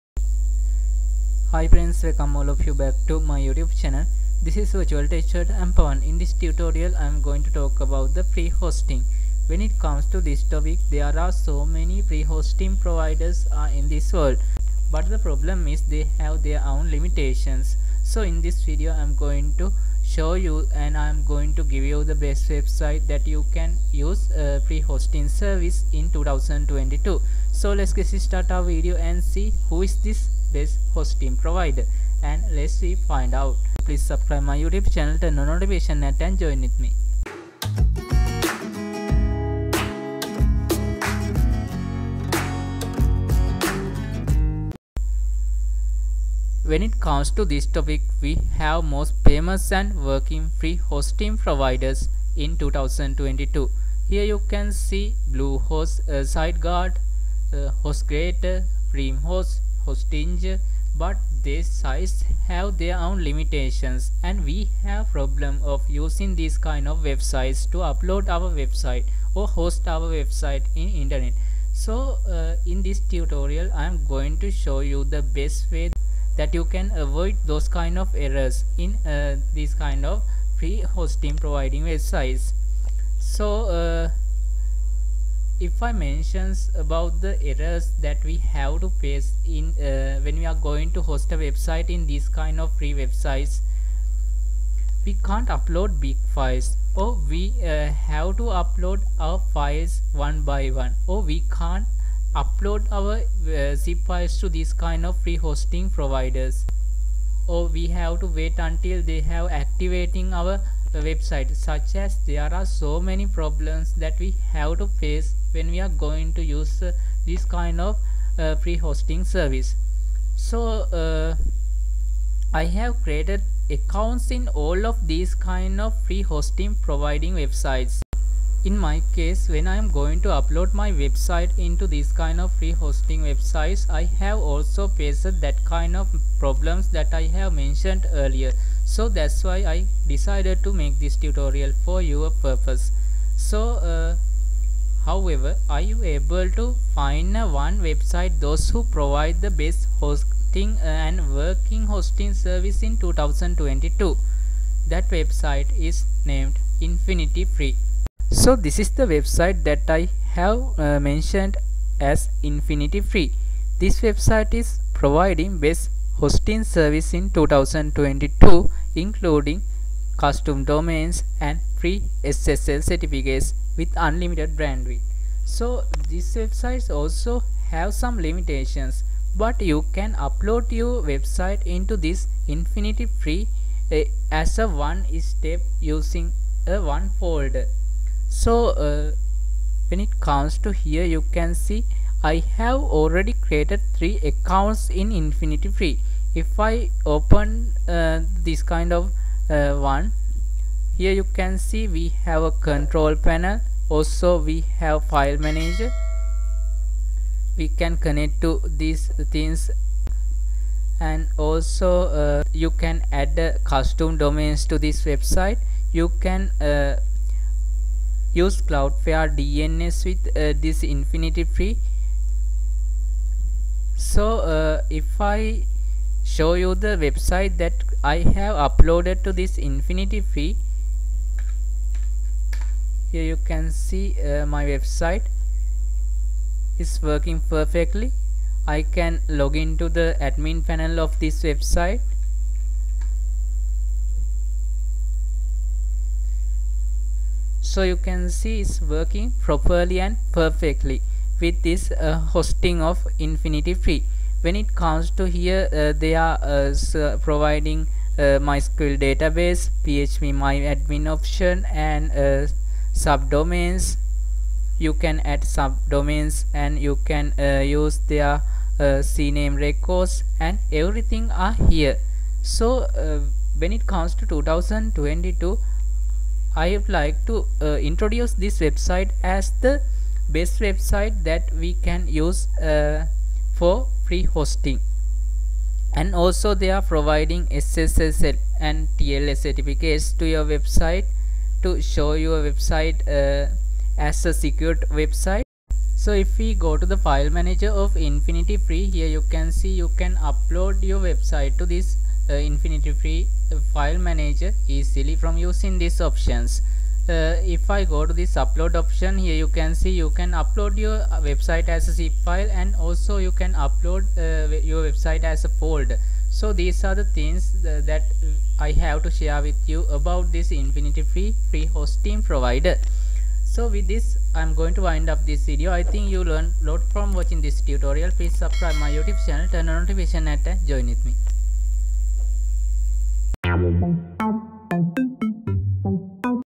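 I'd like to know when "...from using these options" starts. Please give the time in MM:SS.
05:05.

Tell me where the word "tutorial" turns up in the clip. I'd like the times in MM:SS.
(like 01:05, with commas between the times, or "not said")
00:06, 01:12, 02:21, 05:27.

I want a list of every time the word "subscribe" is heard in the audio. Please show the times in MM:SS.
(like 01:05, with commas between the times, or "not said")
00:34, 05:28.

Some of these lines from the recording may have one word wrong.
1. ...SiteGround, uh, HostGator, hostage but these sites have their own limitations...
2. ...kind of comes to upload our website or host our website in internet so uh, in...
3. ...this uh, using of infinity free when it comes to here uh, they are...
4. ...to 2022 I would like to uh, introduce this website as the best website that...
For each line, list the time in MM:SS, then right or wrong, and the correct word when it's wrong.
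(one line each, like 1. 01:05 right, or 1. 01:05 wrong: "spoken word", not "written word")
1. 00:56 right
2. 01:06 wrong: "websites", not "comes"
3. 04:11 wrong: "hosting", not "using"
4. 04:34 right.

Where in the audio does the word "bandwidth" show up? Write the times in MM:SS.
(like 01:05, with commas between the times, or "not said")
02:54.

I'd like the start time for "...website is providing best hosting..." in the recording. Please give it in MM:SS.
02:43.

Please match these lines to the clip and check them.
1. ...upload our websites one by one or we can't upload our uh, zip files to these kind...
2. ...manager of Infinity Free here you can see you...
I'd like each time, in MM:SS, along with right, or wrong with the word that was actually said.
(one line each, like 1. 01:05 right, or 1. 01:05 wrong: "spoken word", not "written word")
1. 01:38 wrong: "files", not "websites"
2. 04:57 right.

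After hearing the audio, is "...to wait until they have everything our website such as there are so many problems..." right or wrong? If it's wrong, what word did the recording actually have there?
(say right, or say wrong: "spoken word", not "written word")
wrong: "activating", not "everything".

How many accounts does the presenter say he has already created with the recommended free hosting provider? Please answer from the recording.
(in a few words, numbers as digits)
3.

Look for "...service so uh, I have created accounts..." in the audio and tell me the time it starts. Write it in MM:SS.
01:59.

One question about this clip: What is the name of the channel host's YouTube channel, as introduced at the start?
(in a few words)
Virtual Teacher.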